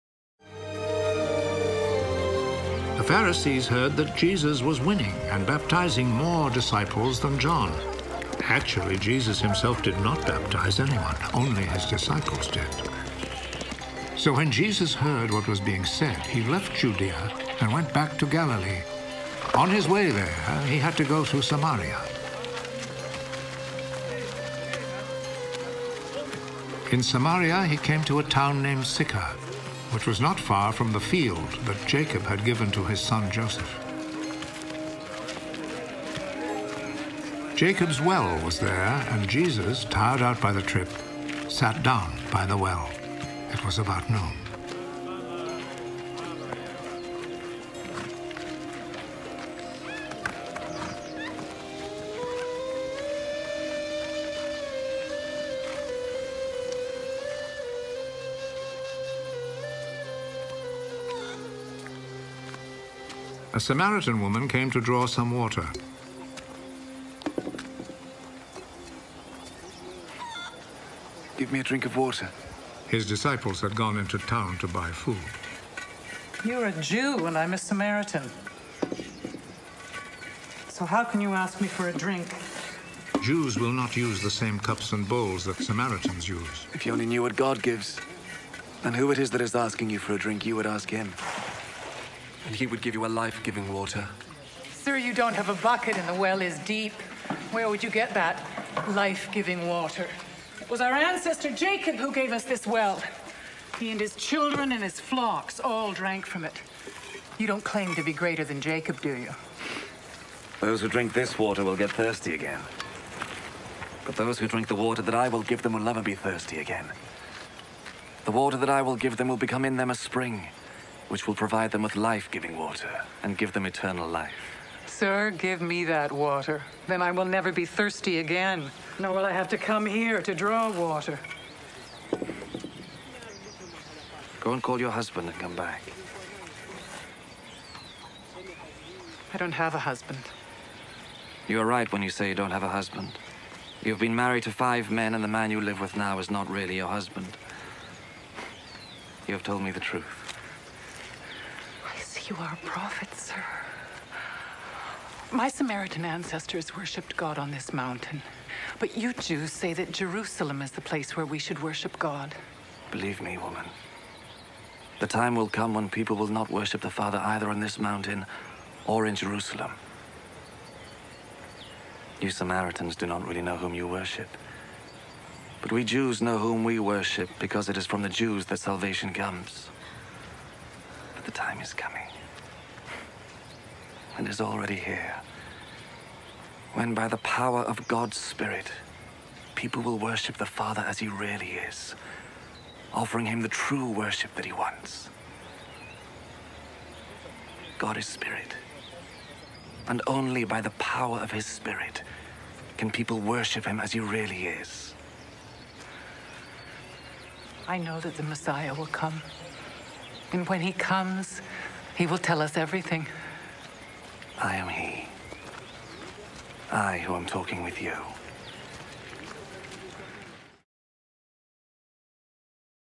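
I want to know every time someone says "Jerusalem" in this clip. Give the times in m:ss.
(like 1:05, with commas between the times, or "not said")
2:39, 2:49.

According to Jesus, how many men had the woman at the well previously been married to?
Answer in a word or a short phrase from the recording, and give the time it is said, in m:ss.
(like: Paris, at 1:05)
5, at 2:24.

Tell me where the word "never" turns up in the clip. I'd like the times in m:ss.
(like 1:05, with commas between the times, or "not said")
1:55, 2:07.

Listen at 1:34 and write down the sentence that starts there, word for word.
Sir, you don't have a bucket and the well is deep.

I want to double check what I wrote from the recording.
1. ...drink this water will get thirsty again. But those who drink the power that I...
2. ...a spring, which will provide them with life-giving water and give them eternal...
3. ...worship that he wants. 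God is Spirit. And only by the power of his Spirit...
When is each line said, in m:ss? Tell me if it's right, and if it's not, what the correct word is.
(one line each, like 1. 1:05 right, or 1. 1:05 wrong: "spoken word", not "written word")
1. 1:50 wrong: "water", not "power"
2. 1:59 right
3. 3:13 right.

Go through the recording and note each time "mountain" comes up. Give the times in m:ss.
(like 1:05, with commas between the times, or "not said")
2:37, 2:47.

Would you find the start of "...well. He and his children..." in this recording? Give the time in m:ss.
1:42.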